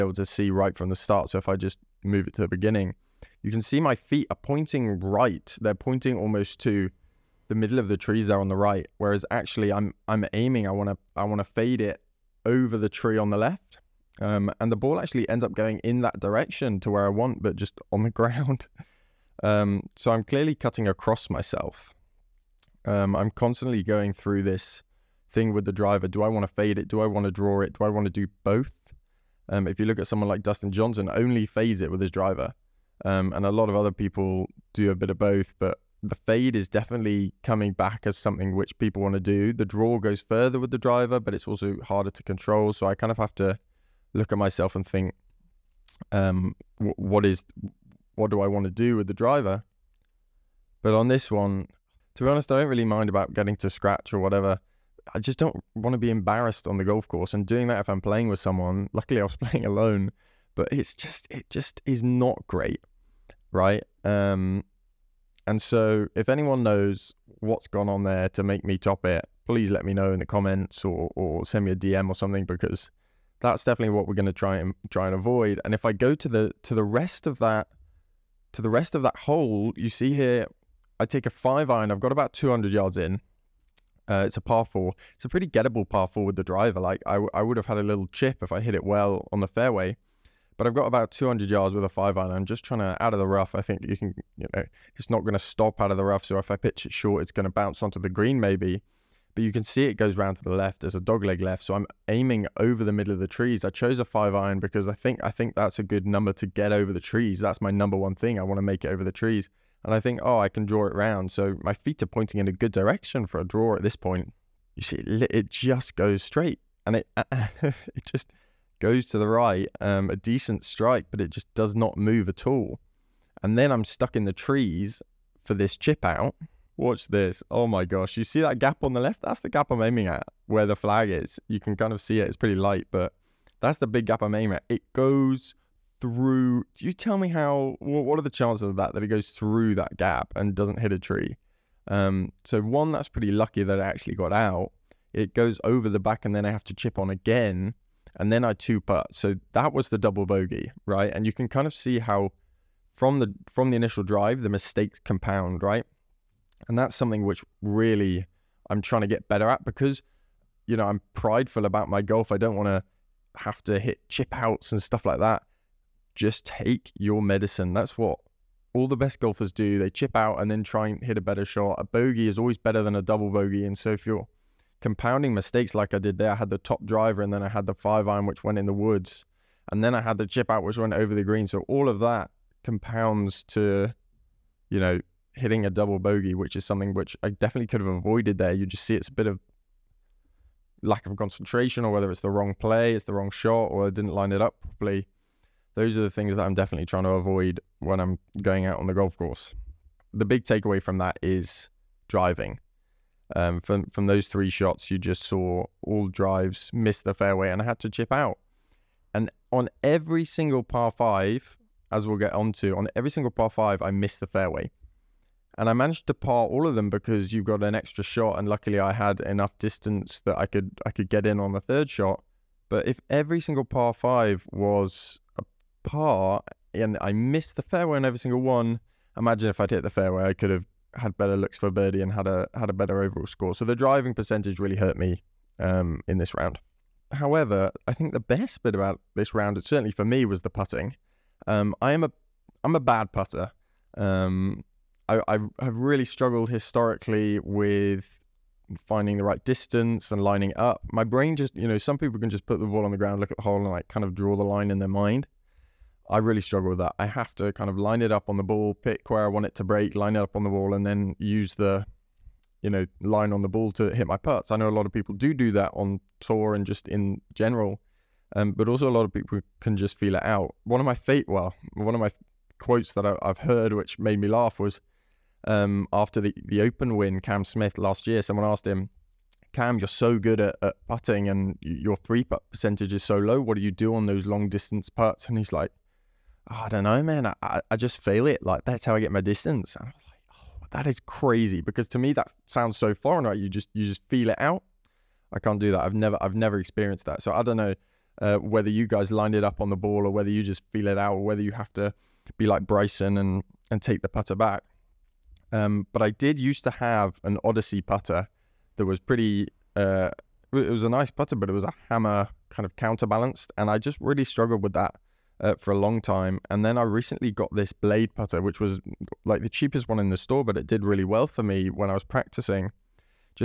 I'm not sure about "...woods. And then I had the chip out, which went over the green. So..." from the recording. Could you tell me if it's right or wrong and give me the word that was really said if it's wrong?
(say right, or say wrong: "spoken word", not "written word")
right.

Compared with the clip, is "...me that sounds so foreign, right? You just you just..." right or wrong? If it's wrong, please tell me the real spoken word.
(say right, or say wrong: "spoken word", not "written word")
right.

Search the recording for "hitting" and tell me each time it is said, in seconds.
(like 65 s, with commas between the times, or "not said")
185 s.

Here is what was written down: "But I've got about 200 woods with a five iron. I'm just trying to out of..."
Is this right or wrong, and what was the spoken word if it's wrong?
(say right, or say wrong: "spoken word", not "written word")
wrong: "yards", not "woods".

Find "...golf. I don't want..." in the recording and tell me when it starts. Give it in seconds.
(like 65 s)
162 s.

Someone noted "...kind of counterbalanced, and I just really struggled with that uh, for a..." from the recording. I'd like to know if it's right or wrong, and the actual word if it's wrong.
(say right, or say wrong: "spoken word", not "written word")
right.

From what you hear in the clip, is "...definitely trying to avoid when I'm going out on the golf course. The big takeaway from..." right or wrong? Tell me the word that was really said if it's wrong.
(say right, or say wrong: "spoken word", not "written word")
right.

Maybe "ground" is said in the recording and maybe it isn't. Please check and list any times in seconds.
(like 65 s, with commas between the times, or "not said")
18 s, 252 s.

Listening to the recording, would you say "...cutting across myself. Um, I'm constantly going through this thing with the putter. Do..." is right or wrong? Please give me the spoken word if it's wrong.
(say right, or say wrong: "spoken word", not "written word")
wrong: "driver", not "putter".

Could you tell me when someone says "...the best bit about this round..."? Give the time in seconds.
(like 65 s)
238 s.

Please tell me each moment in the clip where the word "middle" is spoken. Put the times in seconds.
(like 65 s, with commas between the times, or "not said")
7 s, 102 s.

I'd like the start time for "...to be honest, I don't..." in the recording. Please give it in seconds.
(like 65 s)
52 s.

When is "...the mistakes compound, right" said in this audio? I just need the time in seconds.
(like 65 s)
154 s.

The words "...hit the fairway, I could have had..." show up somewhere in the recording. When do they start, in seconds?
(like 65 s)
229 s.